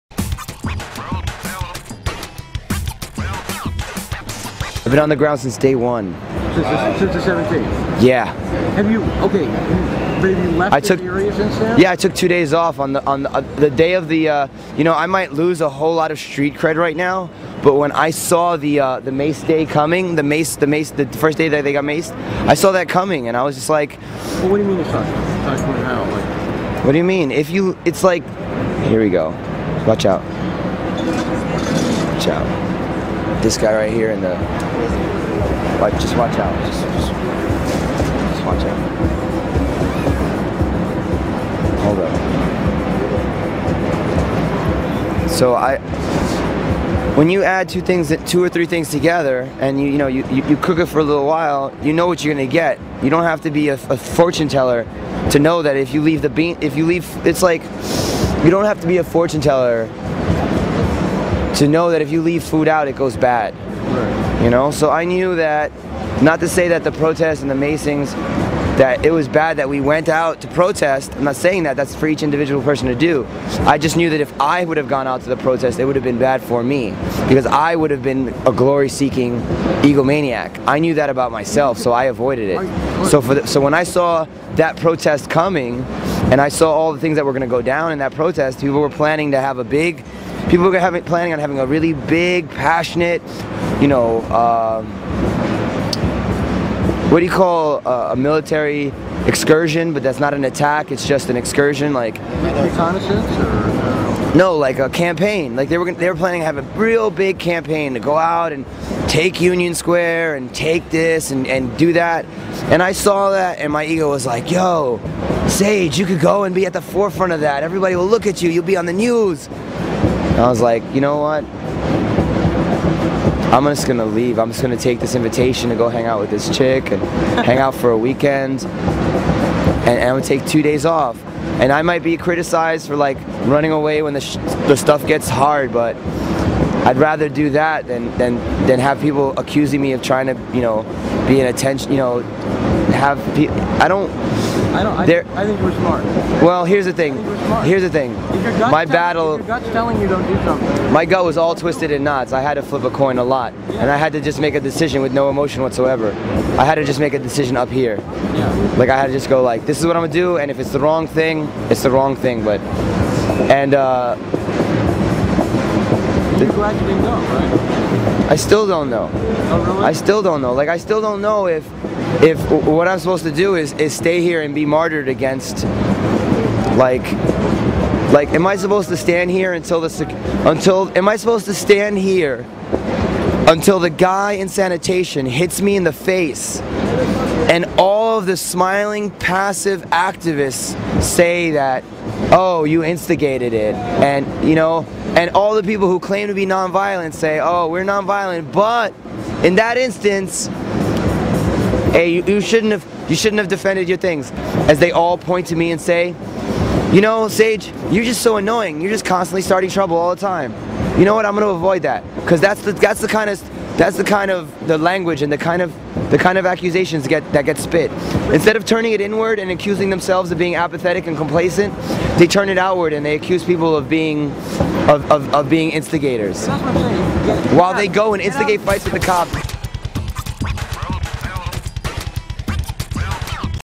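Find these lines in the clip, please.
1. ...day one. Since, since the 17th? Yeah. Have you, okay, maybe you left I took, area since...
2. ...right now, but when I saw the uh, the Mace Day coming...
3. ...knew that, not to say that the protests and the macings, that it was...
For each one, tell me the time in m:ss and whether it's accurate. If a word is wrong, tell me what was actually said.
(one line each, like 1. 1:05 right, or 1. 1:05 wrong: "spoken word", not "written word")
1. 0:05 right
2. 0:16 right
3. 1:05 right.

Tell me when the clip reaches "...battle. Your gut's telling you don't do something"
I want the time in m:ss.
2:28.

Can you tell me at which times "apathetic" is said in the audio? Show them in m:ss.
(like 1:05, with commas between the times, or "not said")
3:40.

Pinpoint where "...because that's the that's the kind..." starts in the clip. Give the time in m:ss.
3:32.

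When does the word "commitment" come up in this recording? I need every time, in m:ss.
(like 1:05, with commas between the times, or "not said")
not said.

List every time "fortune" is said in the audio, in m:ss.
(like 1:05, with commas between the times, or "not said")
0:53, 0:59.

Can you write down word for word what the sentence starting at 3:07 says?
And all of the smiling, passive activists say that, oh, you instigated it.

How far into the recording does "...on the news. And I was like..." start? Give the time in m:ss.
1:58.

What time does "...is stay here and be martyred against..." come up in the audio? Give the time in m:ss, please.
2:53.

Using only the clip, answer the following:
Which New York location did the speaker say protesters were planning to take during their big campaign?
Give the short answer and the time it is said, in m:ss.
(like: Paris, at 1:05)
Union Square, at 1:49.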